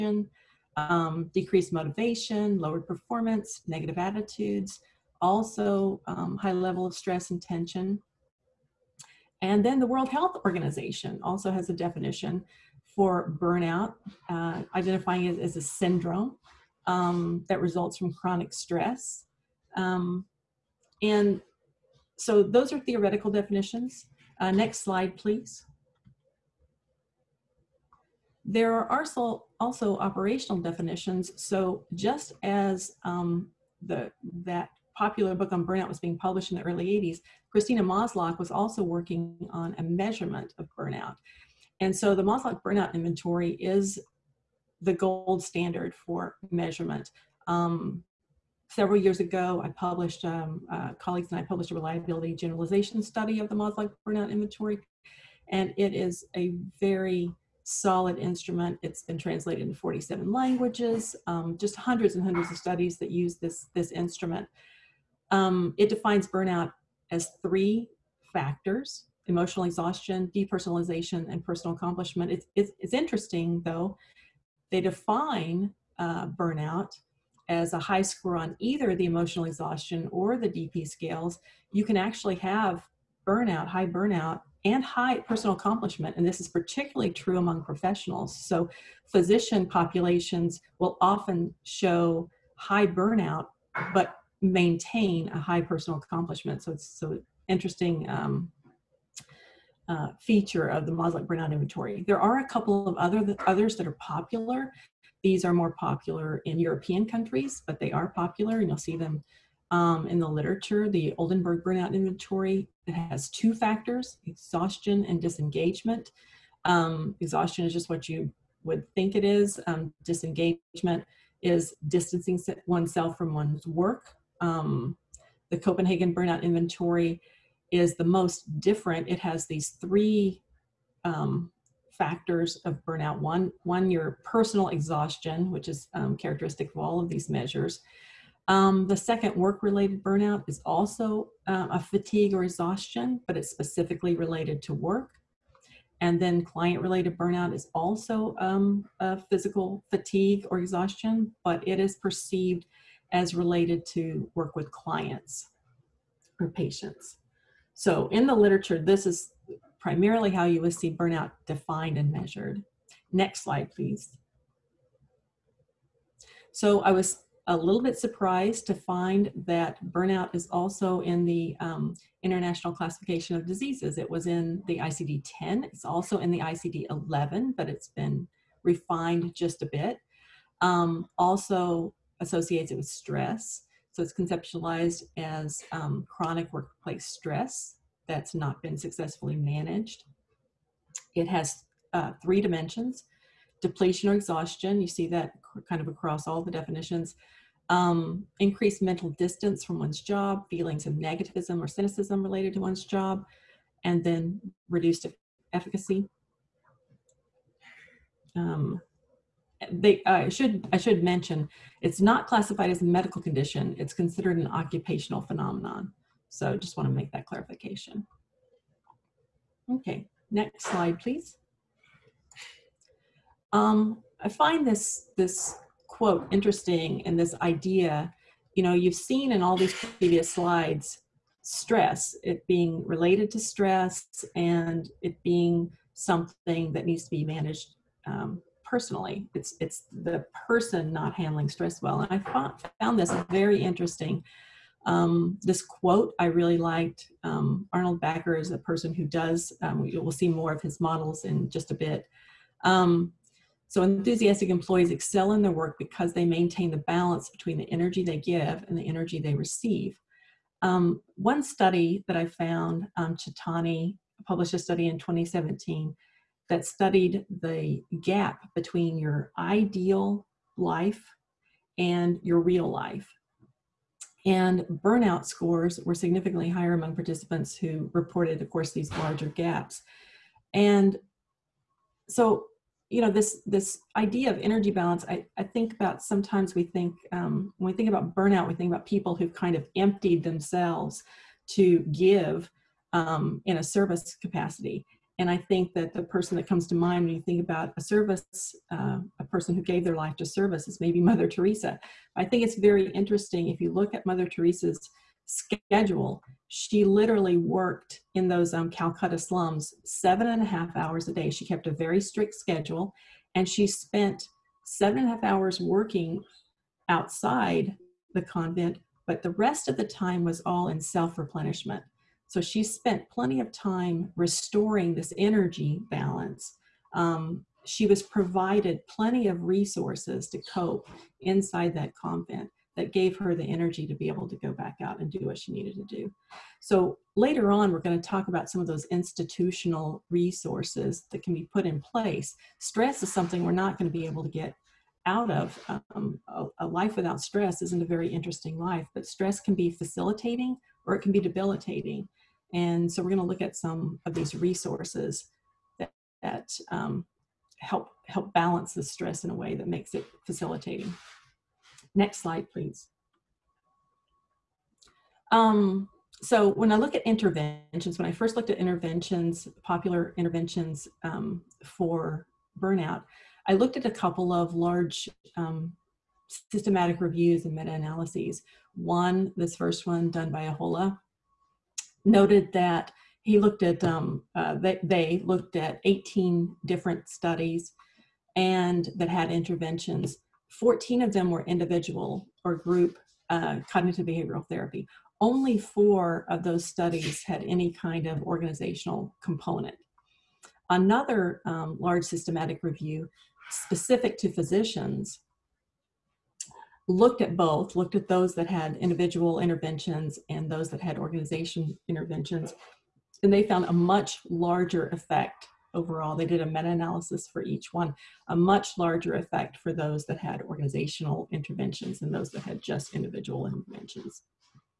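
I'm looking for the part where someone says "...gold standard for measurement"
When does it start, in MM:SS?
00:44.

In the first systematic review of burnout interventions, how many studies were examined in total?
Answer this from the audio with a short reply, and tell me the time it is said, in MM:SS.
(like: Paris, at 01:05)
18, at 06:25.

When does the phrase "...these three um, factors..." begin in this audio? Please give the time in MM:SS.
02:09.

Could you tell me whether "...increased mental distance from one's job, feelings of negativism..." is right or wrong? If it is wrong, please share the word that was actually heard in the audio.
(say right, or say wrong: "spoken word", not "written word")
right.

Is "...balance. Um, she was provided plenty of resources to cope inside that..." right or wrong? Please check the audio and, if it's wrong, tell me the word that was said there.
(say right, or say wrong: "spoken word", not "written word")
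right.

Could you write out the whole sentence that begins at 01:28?
So, physician populations will often show high burnout, but maintain a high personal accomplishment.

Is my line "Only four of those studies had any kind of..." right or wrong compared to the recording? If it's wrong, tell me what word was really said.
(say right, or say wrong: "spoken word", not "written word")
right.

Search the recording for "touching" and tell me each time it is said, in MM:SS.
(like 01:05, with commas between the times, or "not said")
not said.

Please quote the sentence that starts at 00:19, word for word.
Um, and so those are theoretical definitions.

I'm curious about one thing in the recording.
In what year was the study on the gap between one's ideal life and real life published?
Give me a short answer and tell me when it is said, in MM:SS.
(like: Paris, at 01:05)
2017, at 04:24.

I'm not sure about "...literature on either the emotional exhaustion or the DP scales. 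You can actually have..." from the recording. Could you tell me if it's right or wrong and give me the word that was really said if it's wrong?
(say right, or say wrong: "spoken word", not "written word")
wrong: "score", not "literature".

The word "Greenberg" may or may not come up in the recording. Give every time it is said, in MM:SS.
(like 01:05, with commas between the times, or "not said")
not said.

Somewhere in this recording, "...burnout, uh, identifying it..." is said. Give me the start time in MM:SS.
00:13.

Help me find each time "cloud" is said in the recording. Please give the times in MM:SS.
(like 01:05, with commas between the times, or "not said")
not said.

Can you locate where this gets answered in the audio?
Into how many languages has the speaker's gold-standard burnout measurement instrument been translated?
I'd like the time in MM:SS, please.
00:59.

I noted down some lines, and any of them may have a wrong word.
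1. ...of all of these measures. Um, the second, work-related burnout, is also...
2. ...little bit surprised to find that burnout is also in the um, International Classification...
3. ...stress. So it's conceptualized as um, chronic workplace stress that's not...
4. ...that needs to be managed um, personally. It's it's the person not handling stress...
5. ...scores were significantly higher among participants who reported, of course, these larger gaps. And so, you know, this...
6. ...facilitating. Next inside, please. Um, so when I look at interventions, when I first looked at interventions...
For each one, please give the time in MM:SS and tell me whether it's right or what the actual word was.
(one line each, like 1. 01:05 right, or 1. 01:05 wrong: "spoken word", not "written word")
1. 02:16 right
2. 02:47 right
3. 03:02 right
4. 03:56 right
5. 04:35 right
6. 06:00 wrong: "slide", not "inside".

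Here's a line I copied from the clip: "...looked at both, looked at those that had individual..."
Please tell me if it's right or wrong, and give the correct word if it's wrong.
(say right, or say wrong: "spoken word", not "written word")
right.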